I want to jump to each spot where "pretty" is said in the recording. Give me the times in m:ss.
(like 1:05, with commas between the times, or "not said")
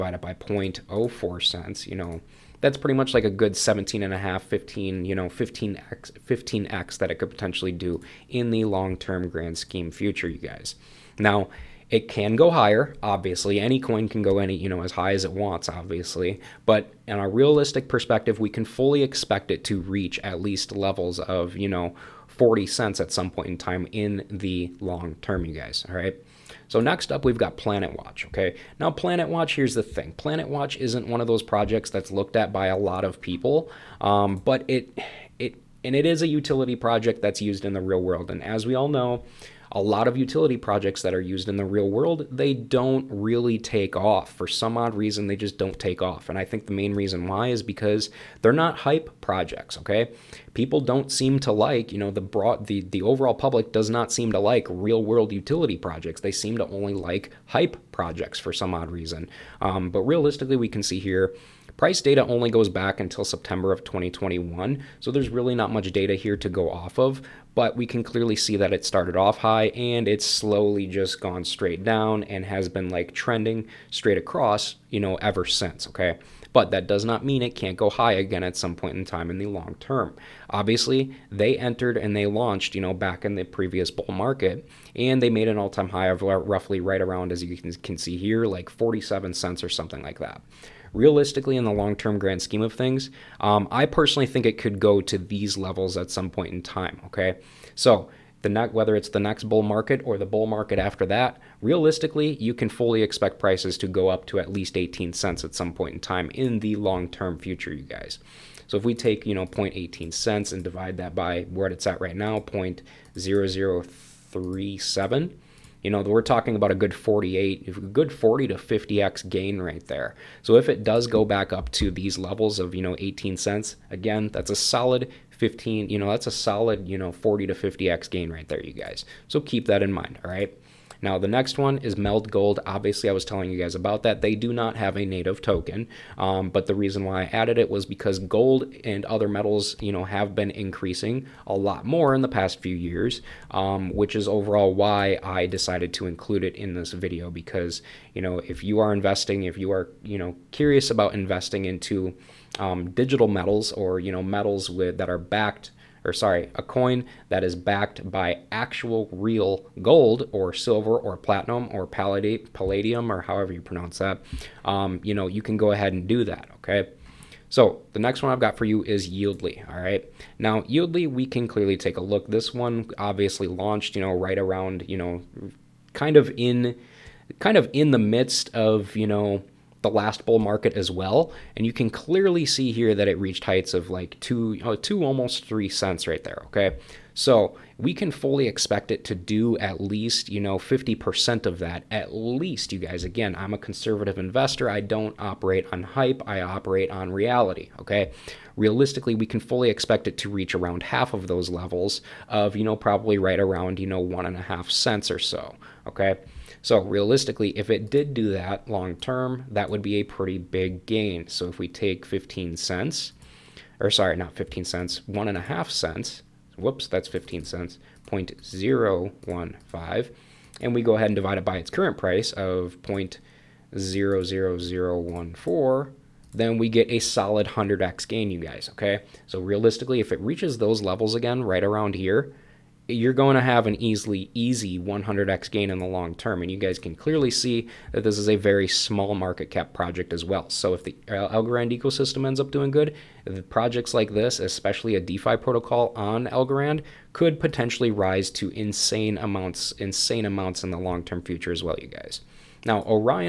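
0:02, 3:30.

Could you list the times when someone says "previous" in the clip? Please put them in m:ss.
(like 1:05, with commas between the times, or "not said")
1:23.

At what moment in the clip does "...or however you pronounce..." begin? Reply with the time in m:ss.
2:43.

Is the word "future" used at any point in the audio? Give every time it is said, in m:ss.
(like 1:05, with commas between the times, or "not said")
0:09, 1:47, 4:11.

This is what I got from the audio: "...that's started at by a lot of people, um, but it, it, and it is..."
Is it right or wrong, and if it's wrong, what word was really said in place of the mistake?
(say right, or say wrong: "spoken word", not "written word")
wrong: "looked", not "started".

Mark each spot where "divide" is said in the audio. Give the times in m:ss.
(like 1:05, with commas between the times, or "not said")
1:50, 3:41.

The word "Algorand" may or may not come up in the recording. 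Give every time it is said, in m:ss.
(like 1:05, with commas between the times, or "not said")
4:01, 4:06.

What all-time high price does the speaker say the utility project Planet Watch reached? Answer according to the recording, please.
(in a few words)
47 cents.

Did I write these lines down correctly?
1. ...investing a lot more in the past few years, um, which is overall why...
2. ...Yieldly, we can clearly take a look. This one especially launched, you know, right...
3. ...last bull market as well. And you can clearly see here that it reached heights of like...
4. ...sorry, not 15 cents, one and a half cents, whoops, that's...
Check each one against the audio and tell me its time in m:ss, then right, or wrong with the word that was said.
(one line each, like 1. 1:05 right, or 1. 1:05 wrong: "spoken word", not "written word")
1. 2:20 wrong: "increasing", not "investing"
2. 2:50 wrong: "obviously", not "especially"
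3. 2:59 right
4. 3:33 right.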